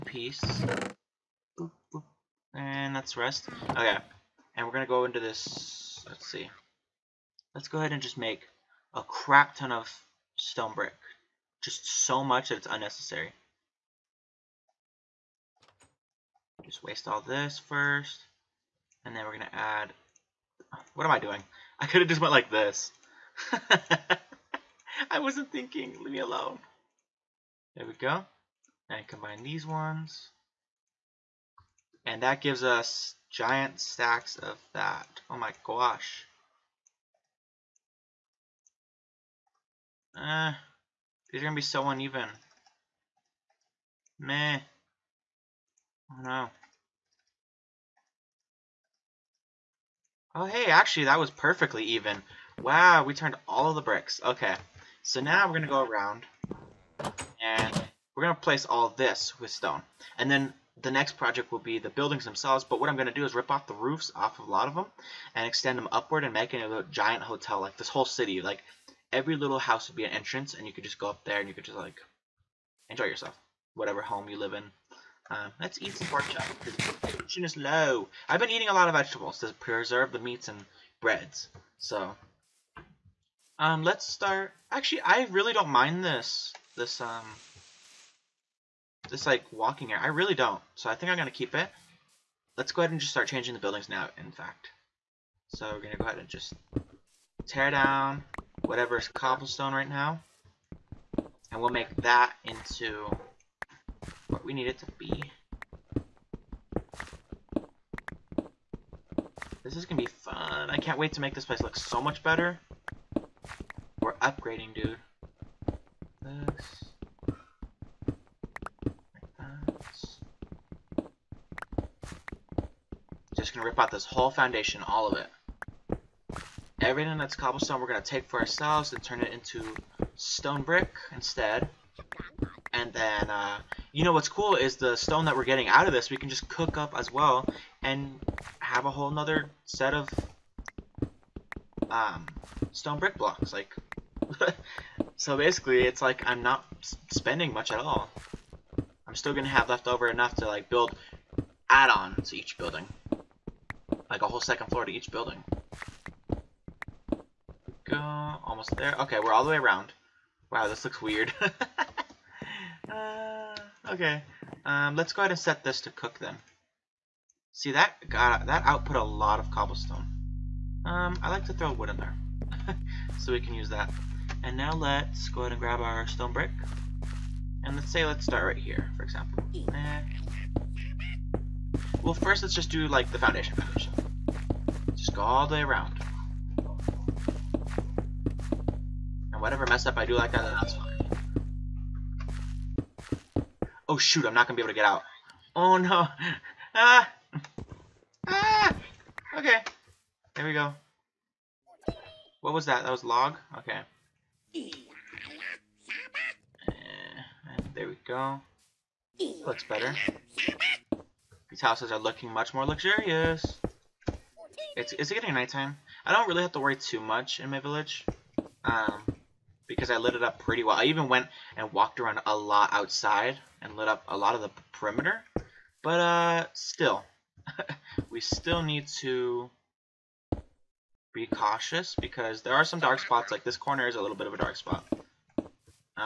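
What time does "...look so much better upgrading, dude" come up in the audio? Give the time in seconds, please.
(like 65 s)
111 s.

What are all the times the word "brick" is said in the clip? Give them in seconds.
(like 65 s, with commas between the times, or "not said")
10 s, 53 s, 130 s, 142 s, 176 s.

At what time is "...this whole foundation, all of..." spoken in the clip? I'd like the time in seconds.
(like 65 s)
123 s.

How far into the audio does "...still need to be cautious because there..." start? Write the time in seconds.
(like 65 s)
228 s.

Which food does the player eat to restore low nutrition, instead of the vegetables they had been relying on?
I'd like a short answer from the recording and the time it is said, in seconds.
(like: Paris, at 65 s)
Pork chop, at 76 s.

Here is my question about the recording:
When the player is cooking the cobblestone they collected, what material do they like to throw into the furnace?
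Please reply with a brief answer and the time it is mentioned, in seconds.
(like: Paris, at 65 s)
Wood, at 171 s.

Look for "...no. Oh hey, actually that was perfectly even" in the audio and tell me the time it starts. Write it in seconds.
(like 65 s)
46 s.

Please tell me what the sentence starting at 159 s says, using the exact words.
Okay, we're all the way around.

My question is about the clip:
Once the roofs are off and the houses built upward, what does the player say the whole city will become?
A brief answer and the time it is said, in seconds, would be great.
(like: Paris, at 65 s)
A giant hotel, at 66 s.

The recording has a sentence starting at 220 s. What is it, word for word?
I even went and walked around a lot outside and lit up a lot of the perimeter.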